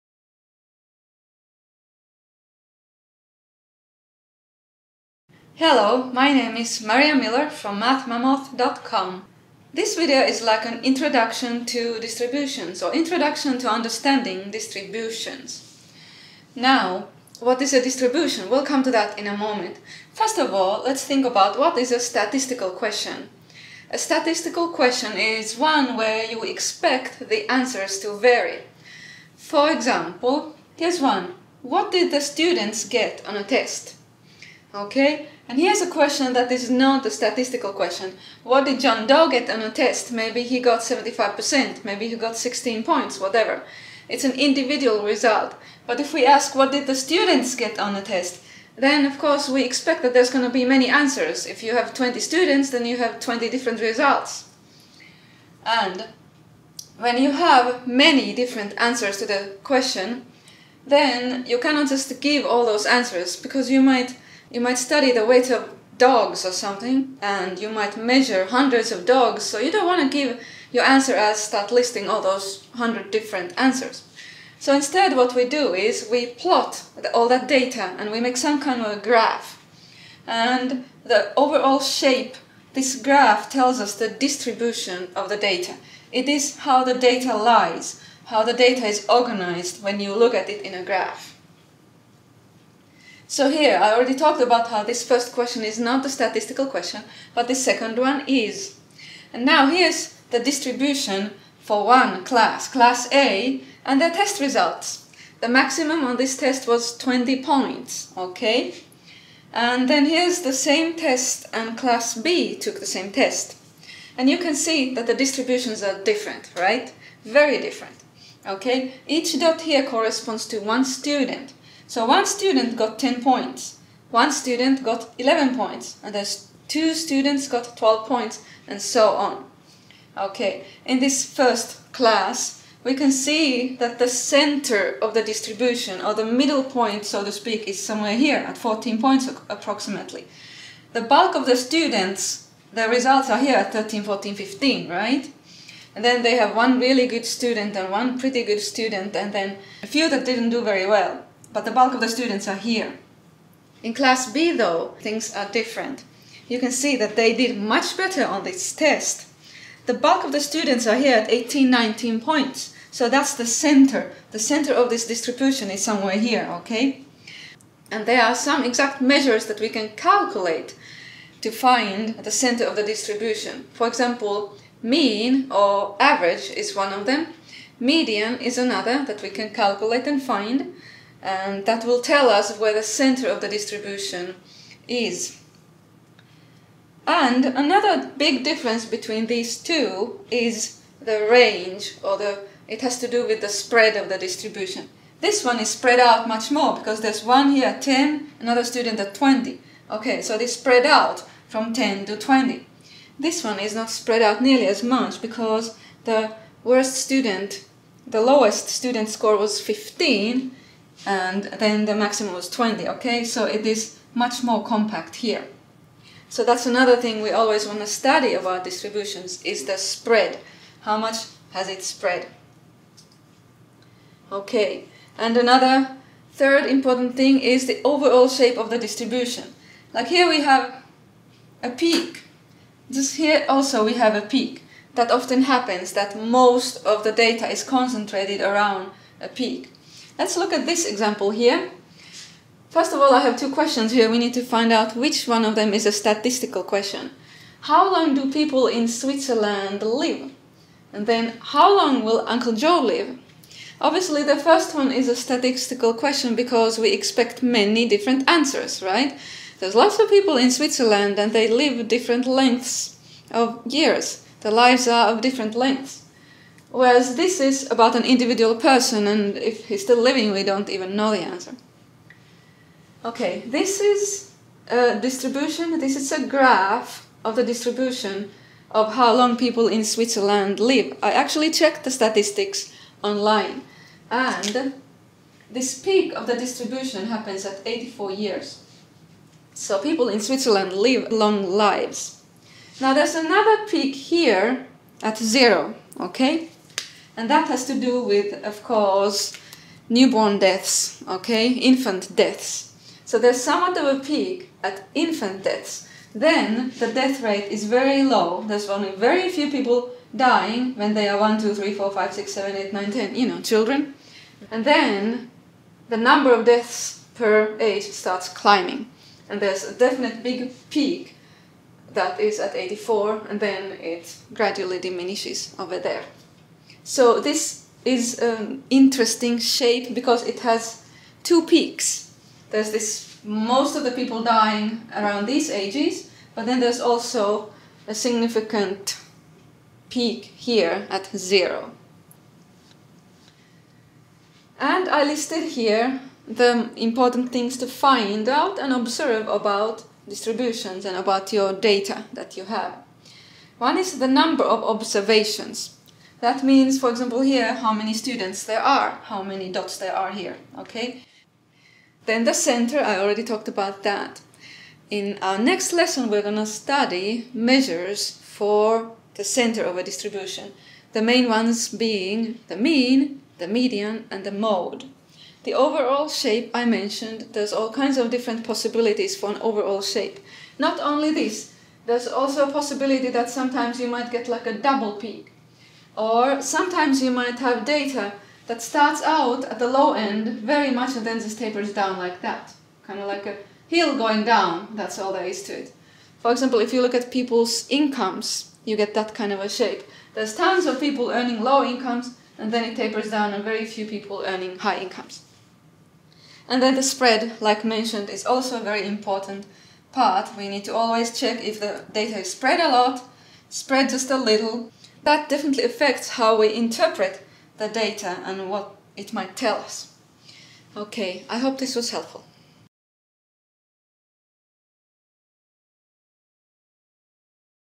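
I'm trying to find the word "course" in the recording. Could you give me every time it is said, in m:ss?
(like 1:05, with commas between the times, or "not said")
0:49, 4:58.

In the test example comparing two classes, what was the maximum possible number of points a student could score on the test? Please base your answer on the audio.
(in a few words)
20 points.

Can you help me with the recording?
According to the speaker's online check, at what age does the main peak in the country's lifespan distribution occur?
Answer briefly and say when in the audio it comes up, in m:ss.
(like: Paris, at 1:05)
84 years, at 4:47.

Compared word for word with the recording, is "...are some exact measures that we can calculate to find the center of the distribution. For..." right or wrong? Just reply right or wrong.
right.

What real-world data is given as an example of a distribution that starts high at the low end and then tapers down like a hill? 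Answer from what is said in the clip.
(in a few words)
people's incomes.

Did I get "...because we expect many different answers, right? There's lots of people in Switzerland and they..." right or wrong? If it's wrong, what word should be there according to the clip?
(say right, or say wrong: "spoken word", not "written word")
right.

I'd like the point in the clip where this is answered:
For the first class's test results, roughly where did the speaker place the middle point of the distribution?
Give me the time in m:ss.
2:18.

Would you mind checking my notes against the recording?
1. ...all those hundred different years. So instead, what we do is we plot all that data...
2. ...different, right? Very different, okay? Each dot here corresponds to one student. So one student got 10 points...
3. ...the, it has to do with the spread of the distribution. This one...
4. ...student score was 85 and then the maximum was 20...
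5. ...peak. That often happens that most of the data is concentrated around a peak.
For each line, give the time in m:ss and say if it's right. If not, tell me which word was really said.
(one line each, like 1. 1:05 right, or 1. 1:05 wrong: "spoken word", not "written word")
1. 1:12 wrong: "answers", not "years"
2. 1:56 right
3. 3:12 right
4. 3:28 wrong: "15", not "85"
5. 3:54 right.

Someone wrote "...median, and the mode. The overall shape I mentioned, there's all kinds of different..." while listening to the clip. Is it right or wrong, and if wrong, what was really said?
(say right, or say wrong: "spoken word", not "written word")
right.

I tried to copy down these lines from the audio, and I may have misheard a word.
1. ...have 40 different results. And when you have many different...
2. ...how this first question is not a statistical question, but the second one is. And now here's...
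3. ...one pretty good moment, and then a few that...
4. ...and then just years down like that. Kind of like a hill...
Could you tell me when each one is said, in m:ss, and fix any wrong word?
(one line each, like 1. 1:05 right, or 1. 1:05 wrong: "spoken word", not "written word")
1. 0:52 wrong: "20", not "40"
2. 1:34 right
3. 2:27 wrong: "student", not "moment"
4. 6:30 wrong: "tapers", not "years".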